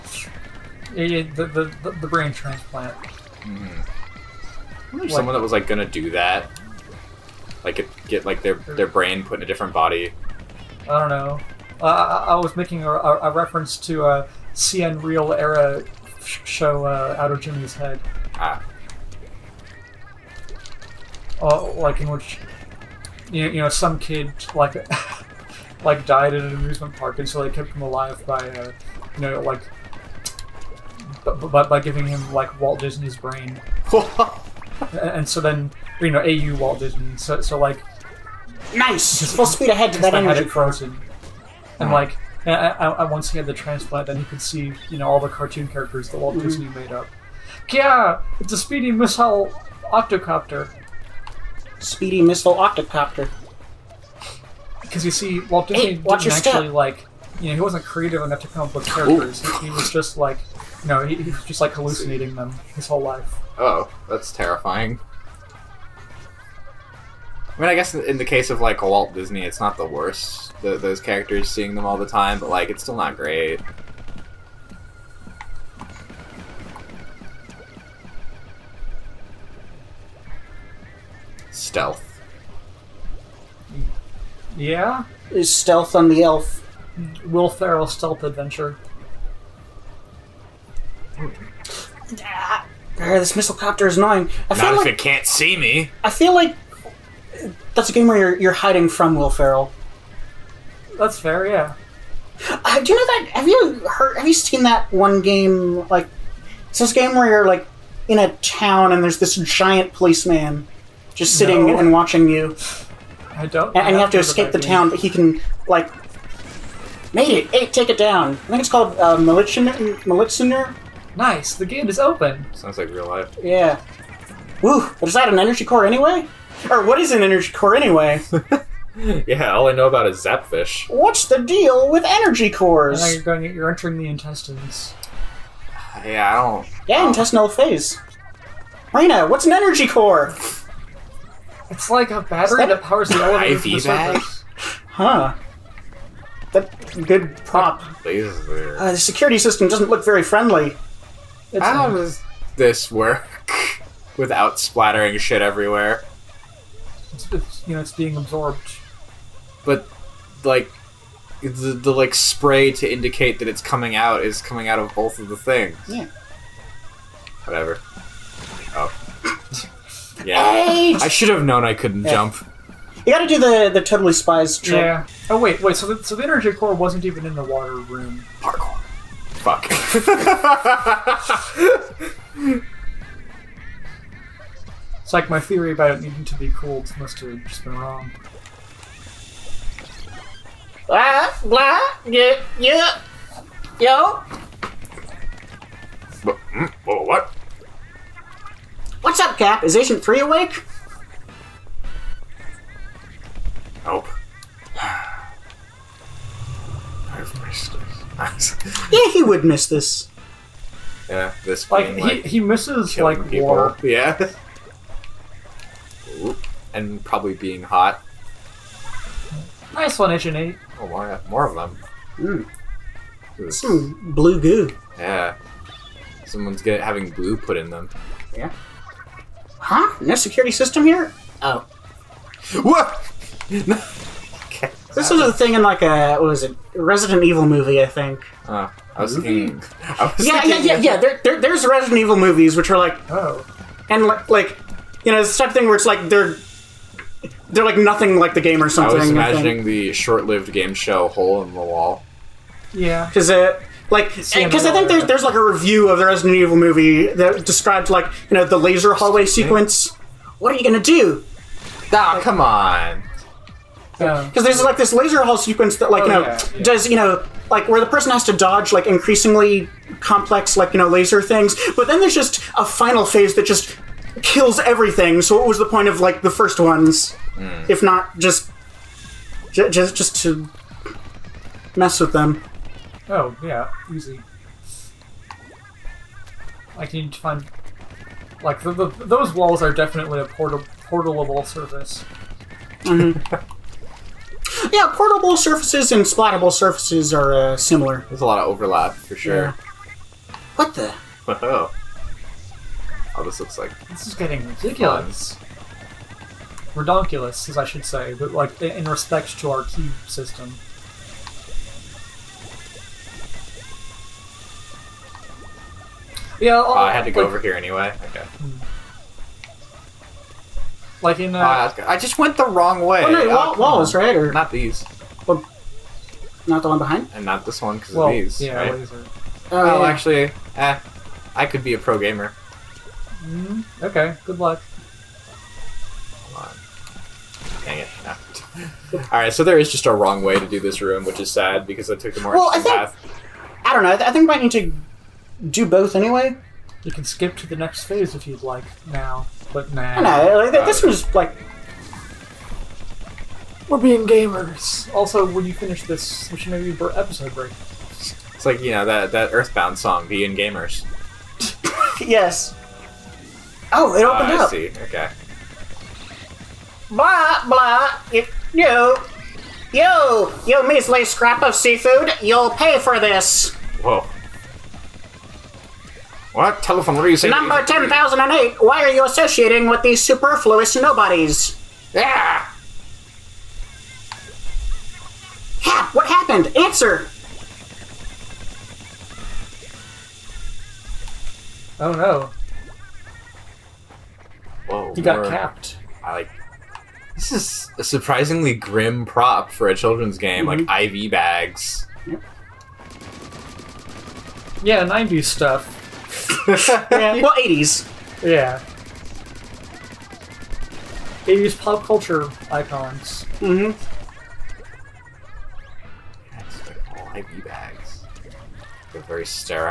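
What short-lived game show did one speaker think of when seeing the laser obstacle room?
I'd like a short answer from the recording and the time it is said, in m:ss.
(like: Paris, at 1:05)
Hole in the Wall, at 4:11.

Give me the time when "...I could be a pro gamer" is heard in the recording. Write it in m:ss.
5:31.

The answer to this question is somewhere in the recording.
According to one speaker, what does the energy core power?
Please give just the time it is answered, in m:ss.
2:23.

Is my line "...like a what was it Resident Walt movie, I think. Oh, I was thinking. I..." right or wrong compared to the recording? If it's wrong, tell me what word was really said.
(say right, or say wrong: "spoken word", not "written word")
wrong: "Evil", not "Walt".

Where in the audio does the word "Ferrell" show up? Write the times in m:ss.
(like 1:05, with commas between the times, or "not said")
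1:27, 1:39.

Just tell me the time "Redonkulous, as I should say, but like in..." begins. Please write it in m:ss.
5:06.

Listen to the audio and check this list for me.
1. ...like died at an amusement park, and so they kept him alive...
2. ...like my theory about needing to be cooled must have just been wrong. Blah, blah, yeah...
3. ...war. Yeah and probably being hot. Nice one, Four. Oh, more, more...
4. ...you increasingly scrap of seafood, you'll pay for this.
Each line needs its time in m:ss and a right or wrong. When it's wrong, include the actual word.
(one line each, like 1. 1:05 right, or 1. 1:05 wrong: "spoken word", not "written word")
1. 0:25 right
2. 3:05 right
3. 3:33 wrong: "Eight", not "Four"
4. 6:10 wrong: "measly", not "increasingly".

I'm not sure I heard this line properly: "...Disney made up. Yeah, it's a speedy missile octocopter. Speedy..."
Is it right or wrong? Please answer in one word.
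right.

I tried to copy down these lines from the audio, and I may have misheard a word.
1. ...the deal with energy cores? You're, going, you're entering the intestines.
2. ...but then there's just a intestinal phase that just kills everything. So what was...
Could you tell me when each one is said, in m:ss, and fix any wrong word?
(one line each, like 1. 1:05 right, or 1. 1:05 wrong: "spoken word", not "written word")
1. 2:11 right
2. 4:31 wrong: "final", not "intestinal".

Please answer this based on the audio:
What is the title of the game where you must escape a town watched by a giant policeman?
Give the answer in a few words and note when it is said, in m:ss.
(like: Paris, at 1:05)
Militsioner, at 1:59.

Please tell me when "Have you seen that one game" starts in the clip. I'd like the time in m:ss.
1:44.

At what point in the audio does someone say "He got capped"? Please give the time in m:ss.
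6:34.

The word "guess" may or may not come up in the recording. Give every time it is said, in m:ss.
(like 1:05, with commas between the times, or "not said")
1:07.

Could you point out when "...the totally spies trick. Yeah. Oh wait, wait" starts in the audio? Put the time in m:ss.
2:53.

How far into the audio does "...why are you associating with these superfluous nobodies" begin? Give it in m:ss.
6:18.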